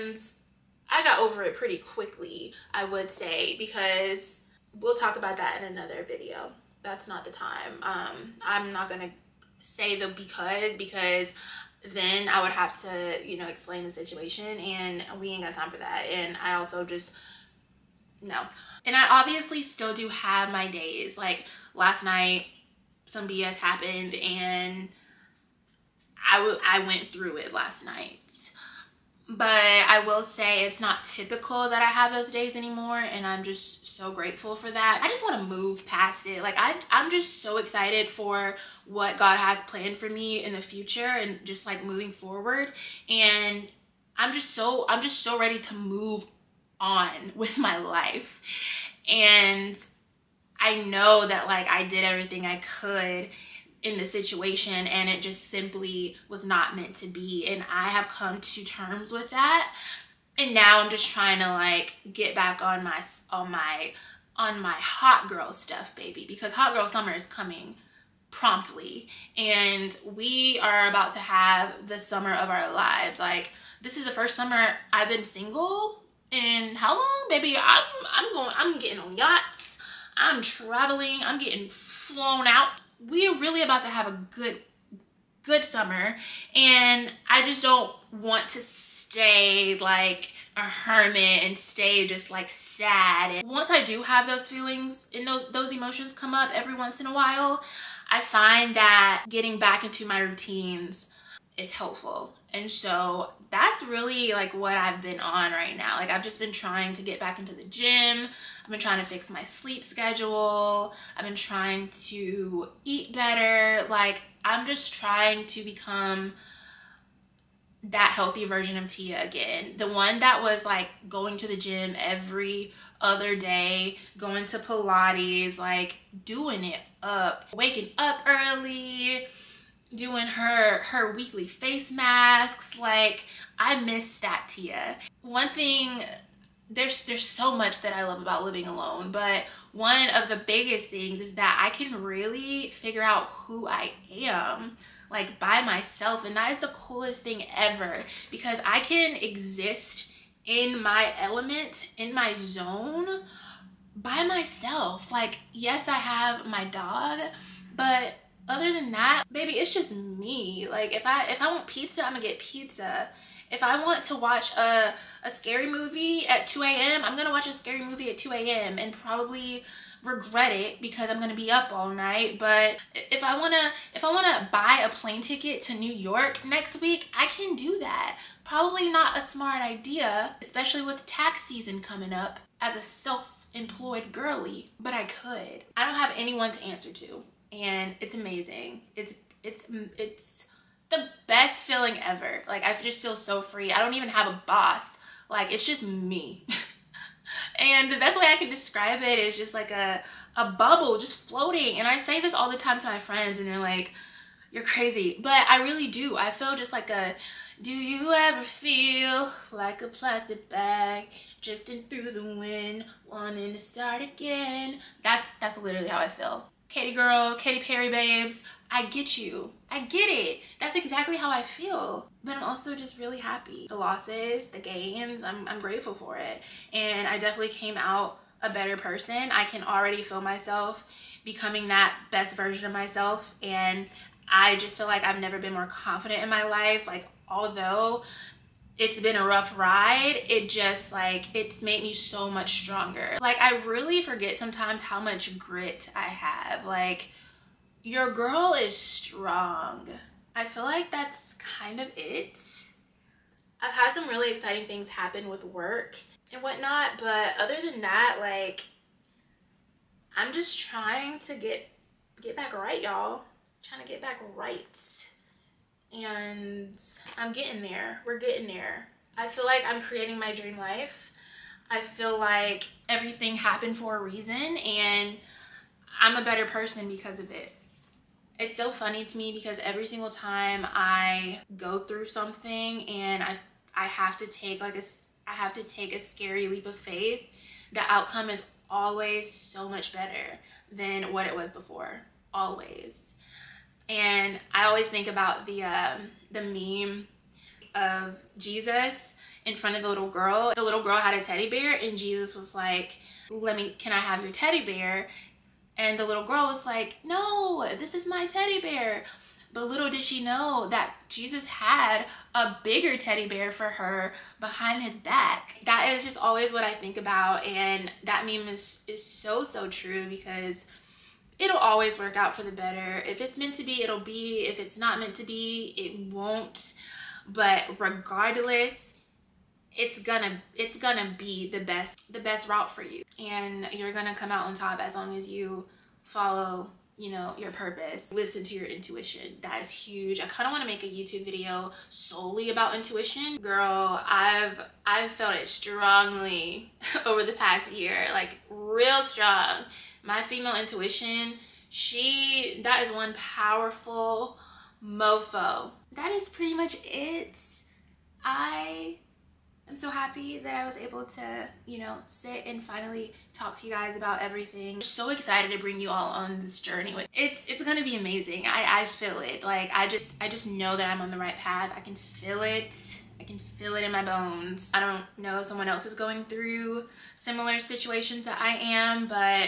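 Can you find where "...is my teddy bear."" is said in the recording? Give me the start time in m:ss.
5:07.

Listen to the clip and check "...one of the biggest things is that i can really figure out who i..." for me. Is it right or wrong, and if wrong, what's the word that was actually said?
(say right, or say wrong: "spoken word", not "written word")
right.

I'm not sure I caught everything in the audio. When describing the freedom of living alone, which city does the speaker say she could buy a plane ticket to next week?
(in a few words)
New York.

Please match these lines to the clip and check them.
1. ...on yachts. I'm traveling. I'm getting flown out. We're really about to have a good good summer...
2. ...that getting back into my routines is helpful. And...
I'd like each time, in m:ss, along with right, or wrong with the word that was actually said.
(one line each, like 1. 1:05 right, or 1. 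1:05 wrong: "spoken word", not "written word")
1. 1:18 right
2. 1:38 right.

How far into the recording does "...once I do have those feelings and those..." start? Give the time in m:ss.
1:33.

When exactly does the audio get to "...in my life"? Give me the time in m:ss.
3:56.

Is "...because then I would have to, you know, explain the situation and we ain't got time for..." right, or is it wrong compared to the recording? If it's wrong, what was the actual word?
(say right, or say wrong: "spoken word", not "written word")
right.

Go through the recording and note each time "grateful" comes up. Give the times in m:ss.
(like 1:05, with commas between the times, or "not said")
0:34, 3:45.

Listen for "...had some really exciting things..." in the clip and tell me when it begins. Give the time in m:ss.
4:13.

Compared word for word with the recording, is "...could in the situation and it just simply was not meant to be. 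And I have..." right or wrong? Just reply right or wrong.
right.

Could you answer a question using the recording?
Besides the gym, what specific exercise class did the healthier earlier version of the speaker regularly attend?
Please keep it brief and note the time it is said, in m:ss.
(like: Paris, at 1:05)
Pilates, at 2:04.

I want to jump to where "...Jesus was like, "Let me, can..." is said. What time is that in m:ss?
5:01.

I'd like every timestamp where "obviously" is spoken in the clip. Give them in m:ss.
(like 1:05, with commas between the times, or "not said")
0:19.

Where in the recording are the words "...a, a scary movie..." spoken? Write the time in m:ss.
2:44.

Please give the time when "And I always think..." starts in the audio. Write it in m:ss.
4:53.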